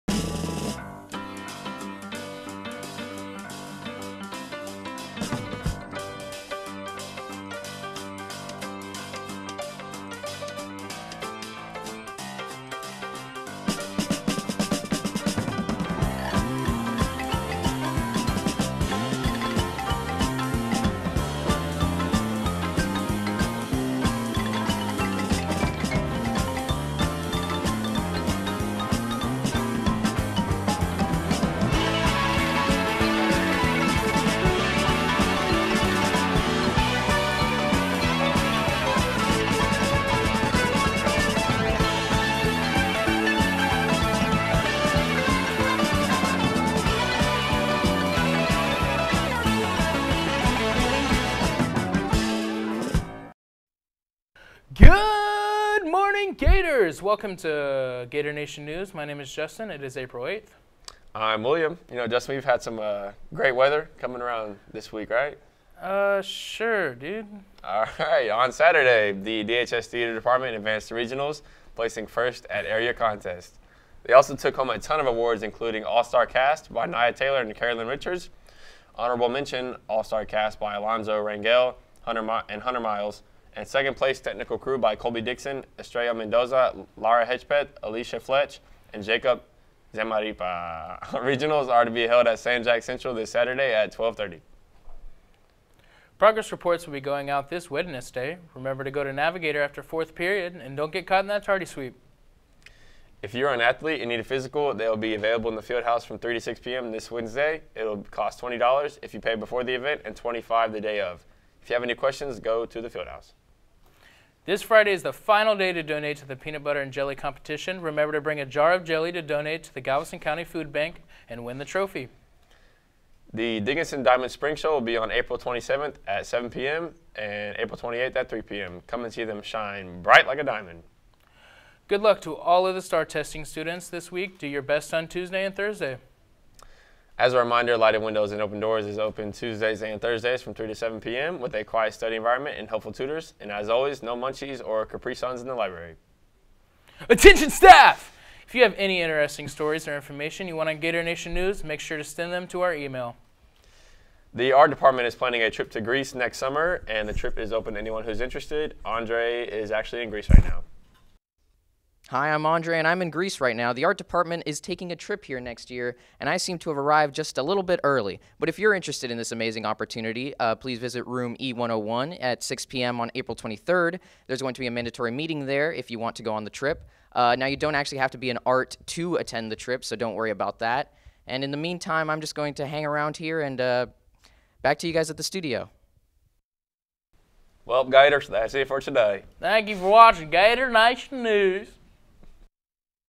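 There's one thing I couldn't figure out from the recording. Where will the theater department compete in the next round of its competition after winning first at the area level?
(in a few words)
San Jac Central.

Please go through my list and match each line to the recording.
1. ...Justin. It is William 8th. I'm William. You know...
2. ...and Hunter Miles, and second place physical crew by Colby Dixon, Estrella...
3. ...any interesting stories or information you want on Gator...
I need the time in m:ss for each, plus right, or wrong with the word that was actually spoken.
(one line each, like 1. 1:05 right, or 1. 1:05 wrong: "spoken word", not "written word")
1. 0:59 wrong: "April", not "William"
2. 1:22 wrong: "technical", not "physical"
3. 2:28 right.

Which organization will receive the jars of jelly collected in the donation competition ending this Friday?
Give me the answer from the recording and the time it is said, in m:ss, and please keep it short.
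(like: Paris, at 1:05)
Galveston County Food Bank, at 1:59.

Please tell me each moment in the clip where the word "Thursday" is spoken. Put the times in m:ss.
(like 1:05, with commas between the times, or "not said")
2:15, 2:20.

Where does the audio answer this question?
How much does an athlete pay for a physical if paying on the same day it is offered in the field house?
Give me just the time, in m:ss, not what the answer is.
1:50.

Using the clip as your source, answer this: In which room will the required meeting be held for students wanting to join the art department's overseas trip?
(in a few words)
E101.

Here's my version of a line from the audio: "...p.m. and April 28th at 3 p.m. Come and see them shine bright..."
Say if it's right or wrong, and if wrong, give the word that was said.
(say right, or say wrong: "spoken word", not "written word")
right.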